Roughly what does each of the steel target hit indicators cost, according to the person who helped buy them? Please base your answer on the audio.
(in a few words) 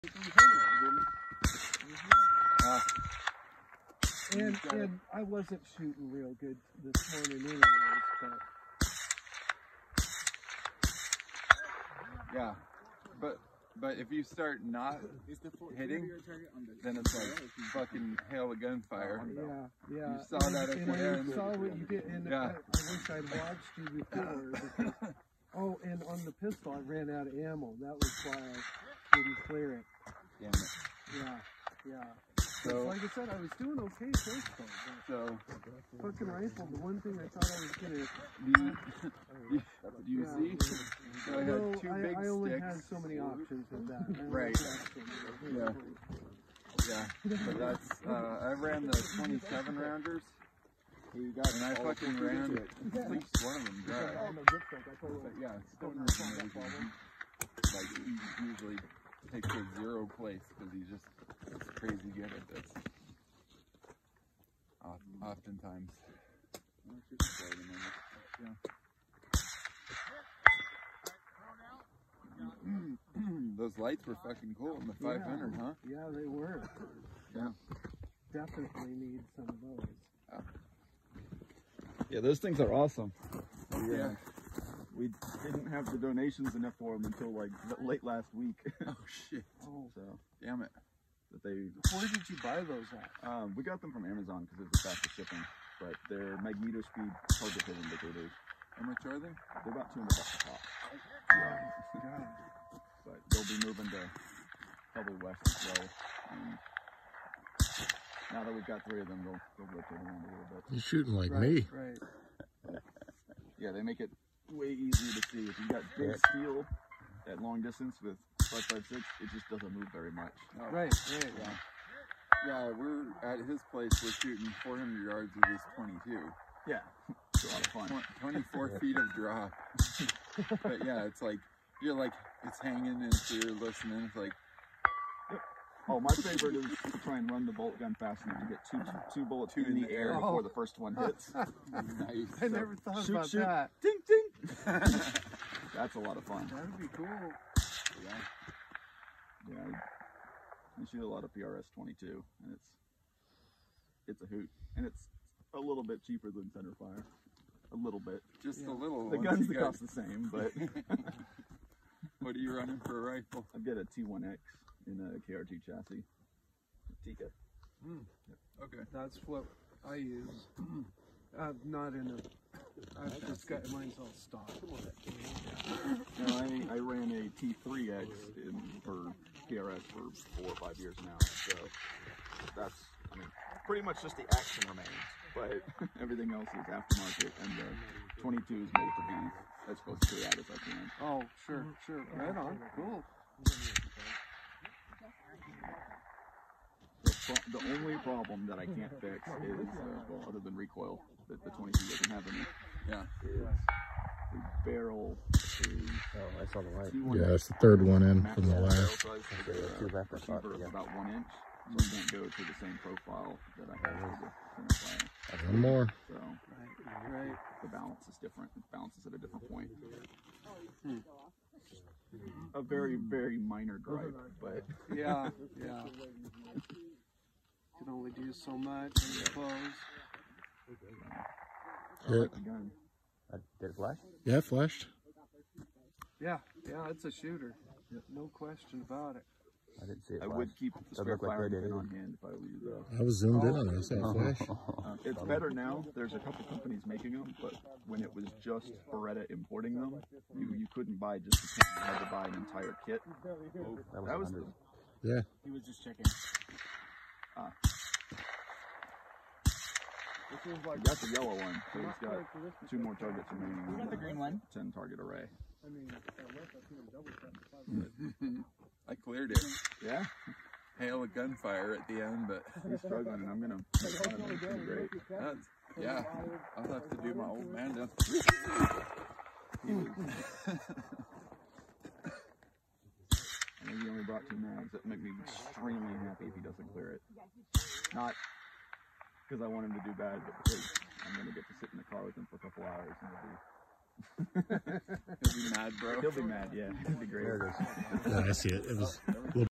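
$200.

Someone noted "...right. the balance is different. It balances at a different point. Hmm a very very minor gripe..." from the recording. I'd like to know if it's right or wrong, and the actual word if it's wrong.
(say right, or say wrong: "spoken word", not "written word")
right.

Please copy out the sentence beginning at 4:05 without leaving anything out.
There's a couple companies making them, but when it was just Beretta importing them, you, you couldn't buy just kit.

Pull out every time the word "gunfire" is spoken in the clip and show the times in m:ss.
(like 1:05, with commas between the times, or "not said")
0:18, 4:31.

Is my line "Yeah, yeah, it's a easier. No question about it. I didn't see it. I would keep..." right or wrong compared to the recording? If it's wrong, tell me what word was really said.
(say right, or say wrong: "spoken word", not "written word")
wrong: "shooter", not "easier".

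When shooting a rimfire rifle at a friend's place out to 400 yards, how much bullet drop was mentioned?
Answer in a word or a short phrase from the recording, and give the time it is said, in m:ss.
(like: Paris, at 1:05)
24 feet, at 2:08.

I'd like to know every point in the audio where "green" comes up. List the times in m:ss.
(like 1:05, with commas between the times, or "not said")
4:23.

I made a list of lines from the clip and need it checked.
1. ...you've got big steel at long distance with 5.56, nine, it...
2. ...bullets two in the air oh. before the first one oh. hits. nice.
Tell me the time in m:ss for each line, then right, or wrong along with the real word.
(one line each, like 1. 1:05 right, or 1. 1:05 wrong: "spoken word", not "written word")
1. 1:55 wrong: "five", not "nine"
2. 2:19 right.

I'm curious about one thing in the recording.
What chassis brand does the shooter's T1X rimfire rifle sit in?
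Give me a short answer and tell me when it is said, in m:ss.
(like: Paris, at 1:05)
KRT, at 2:45.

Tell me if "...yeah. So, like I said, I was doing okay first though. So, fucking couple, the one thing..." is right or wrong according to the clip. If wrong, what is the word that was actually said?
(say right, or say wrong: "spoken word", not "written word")
wrong: "rifle", not "couple".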